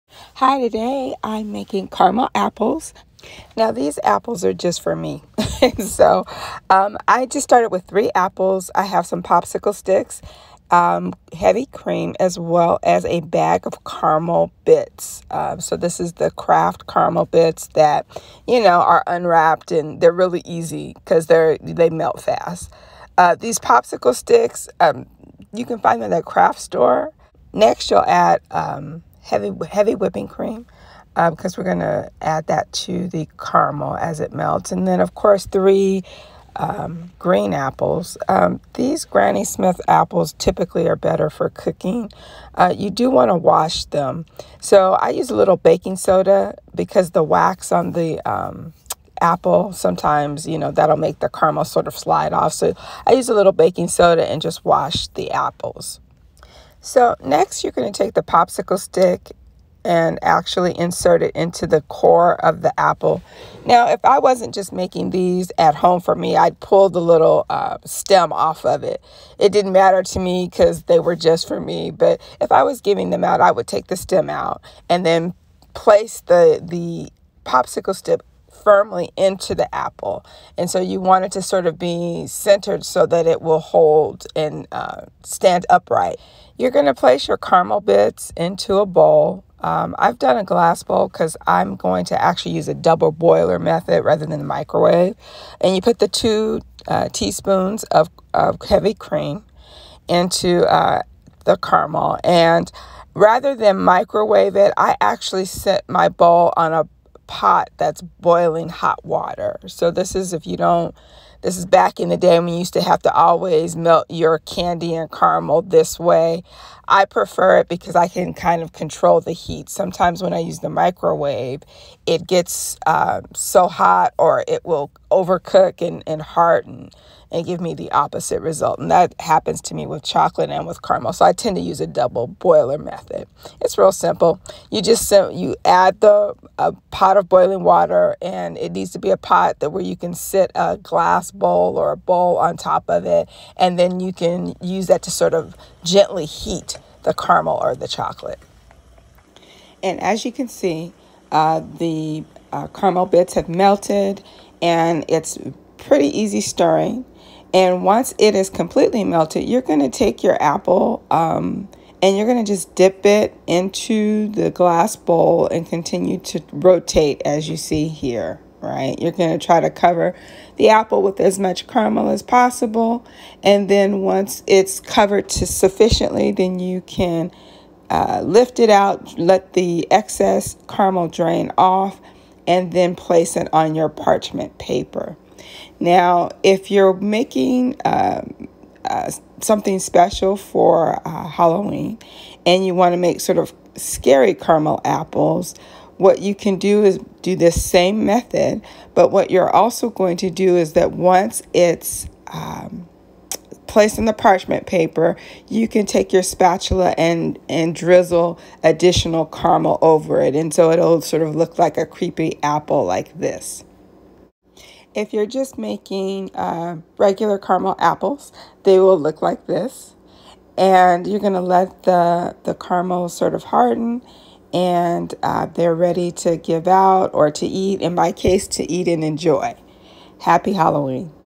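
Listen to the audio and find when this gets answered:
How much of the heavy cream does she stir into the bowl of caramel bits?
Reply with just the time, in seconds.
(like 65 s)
96 s.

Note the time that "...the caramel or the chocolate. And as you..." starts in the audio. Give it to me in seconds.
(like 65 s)
147 s.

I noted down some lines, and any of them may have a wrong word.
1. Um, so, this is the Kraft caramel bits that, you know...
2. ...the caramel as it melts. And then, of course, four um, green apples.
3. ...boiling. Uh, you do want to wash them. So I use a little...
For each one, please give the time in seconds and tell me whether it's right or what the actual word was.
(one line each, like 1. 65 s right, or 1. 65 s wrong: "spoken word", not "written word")
1. 15 s right
2. 33 s wrong: "three", not "four"
3. 41 s wrong: "cooking", not "boiling".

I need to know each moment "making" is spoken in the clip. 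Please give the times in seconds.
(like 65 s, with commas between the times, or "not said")
1 s, 64 s, 186 s, 215 s.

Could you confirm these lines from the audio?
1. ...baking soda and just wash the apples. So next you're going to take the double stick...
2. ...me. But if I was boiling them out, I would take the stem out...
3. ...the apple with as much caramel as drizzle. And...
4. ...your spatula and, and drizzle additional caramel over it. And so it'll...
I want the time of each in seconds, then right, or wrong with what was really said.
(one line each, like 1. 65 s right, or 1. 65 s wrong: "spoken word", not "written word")
1. 53 s wrong: "popsicle", not "double"
2. 71 s wrong: "giving", not "boiling"
3. 170 s wrong: "possible", not "drizzle"
4. 206 s right.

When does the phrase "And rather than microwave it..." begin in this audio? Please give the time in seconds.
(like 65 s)
102 s.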